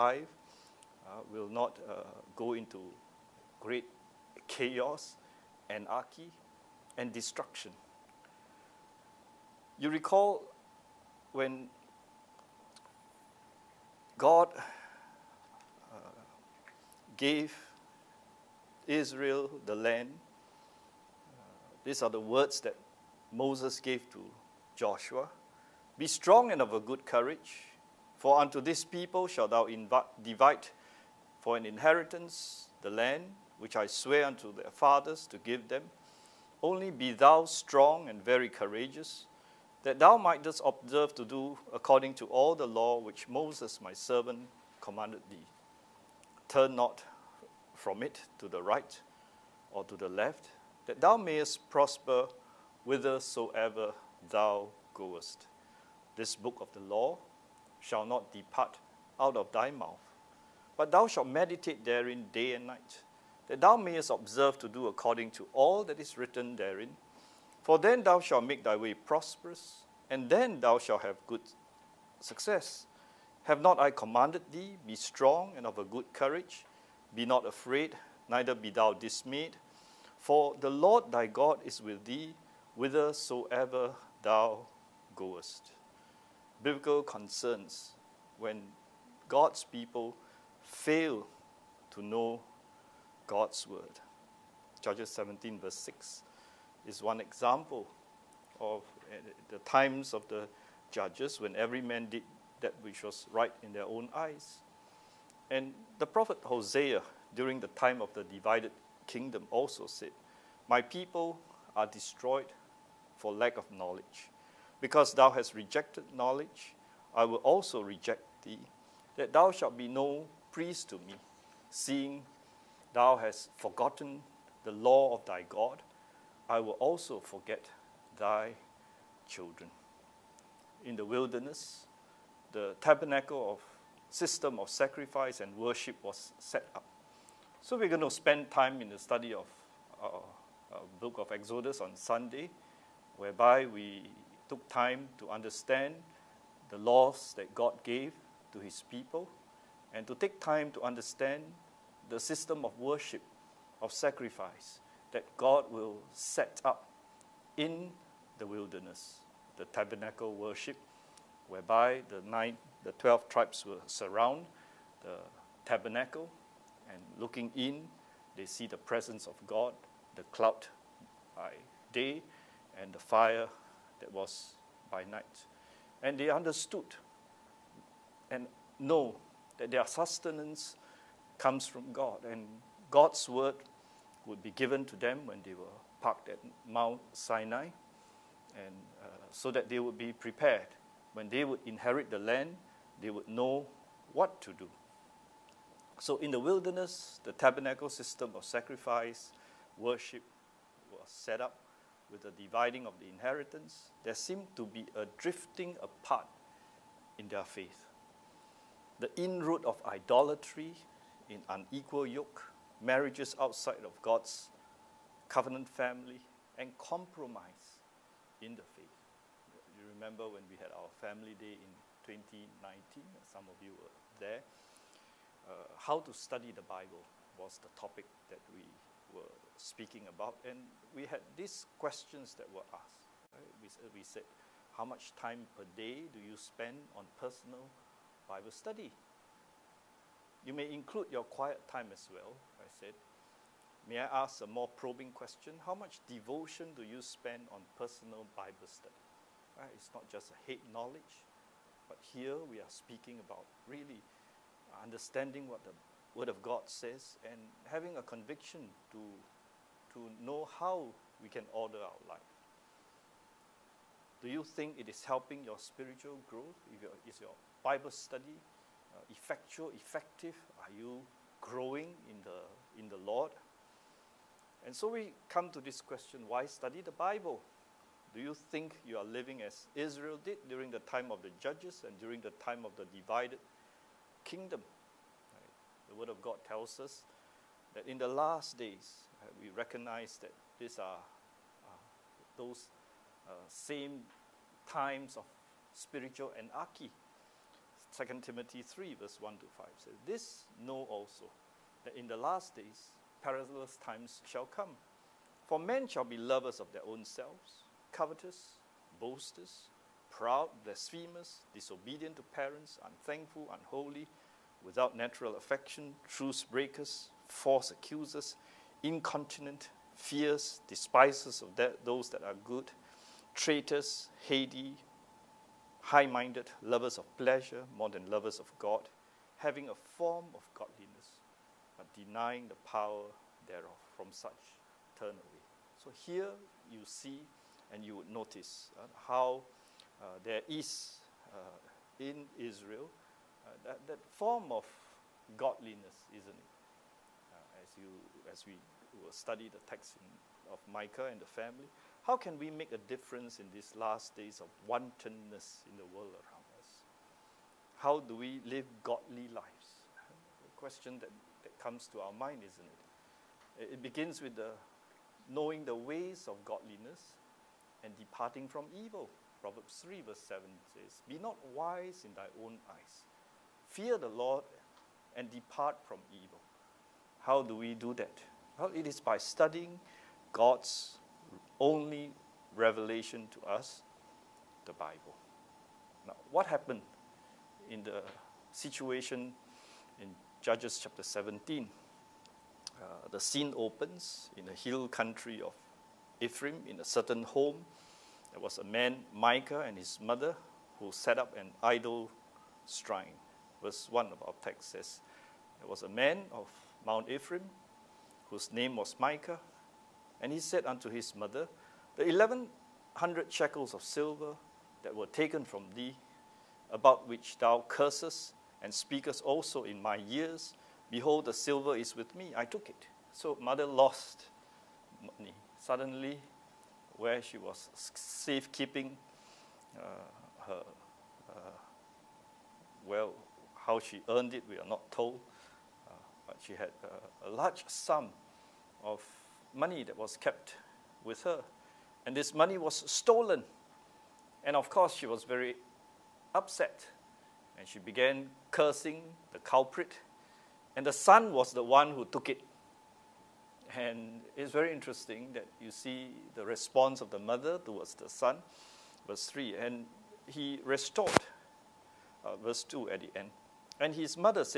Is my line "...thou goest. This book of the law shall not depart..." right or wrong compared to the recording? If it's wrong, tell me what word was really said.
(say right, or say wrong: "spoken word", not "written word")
right.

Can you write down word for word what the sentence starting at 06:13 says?
Fear the Lord and depart from evil.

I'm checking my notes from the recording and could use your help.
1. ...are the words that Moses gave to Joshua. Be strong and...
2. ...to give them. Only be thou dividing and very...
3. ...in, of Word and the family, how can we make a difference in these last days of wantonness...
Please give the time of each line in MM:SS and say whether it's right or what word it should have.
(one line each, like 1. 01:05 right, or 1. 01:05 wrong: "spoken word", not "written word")
1. 00:22 right
2. 00:35 wrong: "strong", not "dividing"
3. 05:49 wrong: "Micah", not "Word".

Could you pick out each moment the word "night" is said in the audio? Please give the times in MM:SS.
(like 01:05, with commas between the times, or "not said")
01:02, 02:55.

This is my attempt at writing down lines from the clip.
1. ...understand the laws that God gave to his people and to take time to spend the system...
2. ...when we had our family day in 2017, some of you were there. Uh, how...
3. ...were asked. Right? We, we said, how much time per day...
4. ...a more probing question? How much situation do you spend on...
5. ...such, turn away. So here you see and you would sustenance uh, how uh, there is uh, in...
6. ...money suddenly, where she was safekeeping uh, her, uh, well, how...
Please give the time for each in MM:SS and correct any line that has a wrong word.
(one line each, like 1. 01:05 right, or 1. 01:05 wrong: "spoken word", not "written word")
1. 02:25 wrong: "understand", not "spend"
2. 03:40 wrong: "2019", not "2017"
3. 03:52 right
4. 04:04 wrong: "devotion", not "situation"
5. 05:34 wrong: "notice", not "sustenance"
6. 07:05 right.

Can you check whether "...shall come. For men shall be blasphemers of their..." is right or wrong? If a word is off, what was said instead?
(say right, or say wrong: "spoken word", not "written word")
wrong: "lovers", not "blasphemers".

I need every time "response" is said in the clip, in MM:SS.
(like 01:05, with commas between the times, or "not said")
07:36.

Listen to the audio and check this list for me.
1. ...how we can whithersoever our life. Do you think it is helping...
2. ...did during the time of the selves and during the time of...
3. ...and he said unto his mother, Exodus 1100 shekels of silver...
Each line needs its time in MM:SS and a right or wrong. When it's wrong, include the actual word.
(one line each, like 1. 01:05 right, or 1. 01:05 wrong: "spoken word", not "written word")
1. 04:20 wrong: "order", not "whithersoever"
2. 04:40 wrong: "judges", not "selves"
3. 06:50 wrong: "The", not "Exodus".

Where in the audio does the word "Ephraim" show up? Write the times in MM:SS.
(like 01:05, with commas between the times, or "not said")
06:36, 06:47.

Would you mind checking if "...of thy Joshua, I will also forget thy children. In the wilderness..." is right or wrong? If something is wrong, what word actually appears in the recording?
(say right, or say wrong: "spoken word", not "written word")
wrong: "God", not "Joshua".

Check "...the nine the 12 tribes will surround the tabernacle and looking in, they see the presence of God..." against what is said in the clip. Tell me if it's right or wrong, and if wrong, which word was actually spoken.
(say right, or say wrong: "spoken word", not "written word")
right.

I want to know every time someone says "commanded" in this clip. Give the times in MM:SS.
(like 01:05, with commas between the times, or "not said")
00:44, 01:13.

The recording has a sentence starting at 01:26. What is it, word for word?
Biblical concerns when God's people fail to know God's word.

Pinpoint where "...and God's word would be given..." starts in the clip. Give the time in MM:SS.
03:02.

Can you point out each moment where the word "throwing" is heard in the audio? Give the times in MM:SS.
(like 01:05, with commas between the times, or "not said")
not said.